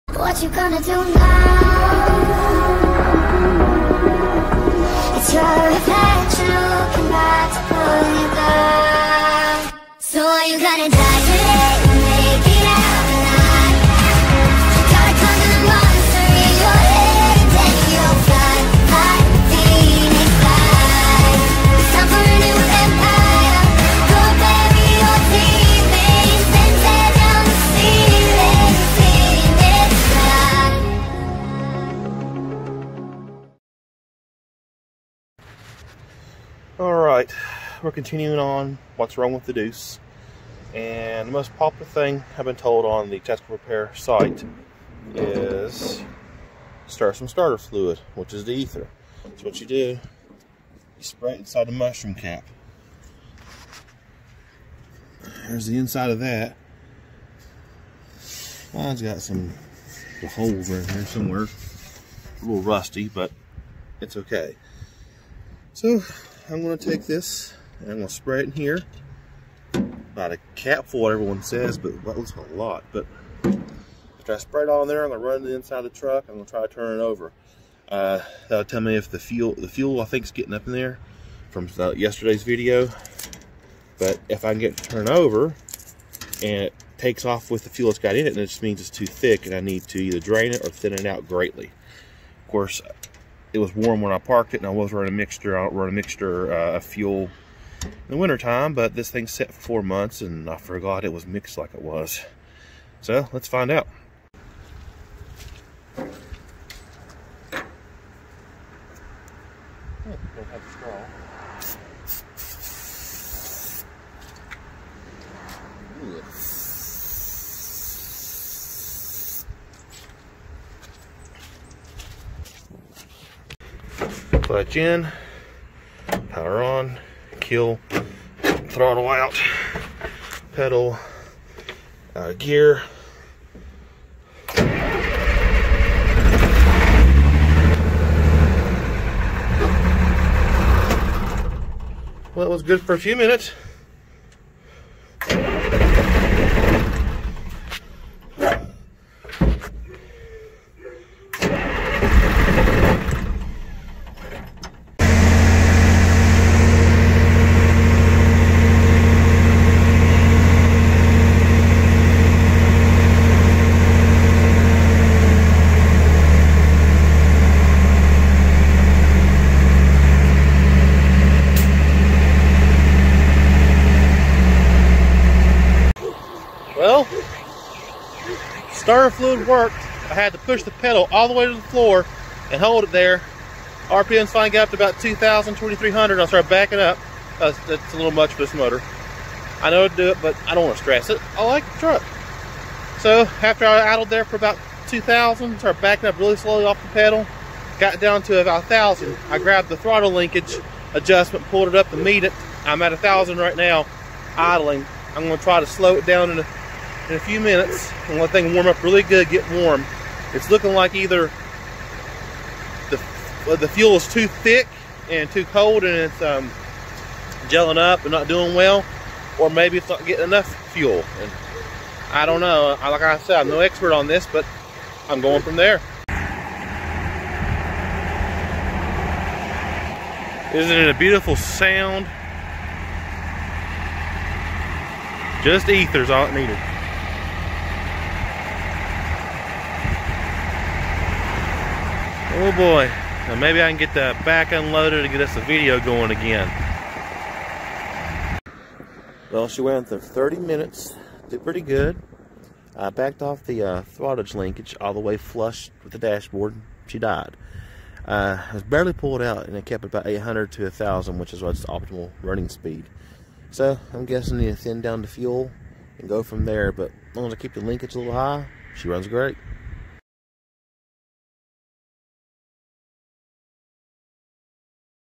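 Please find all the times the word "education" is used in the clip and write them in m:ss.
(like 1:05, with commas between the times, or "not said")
not said.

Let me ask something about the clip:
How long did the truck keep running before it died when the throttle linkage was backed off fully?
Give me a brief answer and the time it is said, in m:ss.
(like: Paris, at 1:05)
30 minutes, at 4:09.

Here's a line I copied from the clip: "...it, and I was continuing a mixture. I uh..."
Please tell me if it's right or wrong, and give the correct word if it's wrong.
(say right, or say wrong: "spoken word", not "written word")
wrong: "running", not "continuing".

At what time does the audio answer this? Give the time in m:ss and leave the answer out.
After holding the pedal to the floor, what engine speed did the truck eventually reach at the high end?
3:05.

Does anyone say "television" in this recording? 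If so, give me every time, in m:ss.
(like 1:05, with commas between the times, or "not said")
not said.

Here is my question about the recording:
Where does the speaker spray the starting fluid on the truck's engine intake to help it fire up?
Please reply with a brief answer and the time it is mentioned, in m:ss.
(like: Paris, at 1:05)
Inside the mushroom cap, at 0:51.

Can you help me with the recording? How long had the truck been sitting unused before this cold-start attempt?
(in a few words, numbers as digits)
4 months.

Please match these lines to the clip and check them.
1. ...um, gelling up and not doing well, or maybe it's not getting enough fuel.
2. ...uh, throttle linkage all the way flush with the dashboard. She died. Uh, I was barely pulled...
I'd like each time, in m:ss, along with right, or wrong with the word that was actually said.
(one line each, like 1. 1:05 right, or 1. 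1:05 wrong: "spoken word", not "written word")
1. 3:36 right
2. 4:13 right.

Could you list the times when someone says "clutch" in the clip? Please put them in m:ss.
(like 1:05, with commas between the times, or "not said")
2:04.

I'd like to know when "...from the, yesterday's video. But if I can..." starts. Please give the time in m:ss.
1:21.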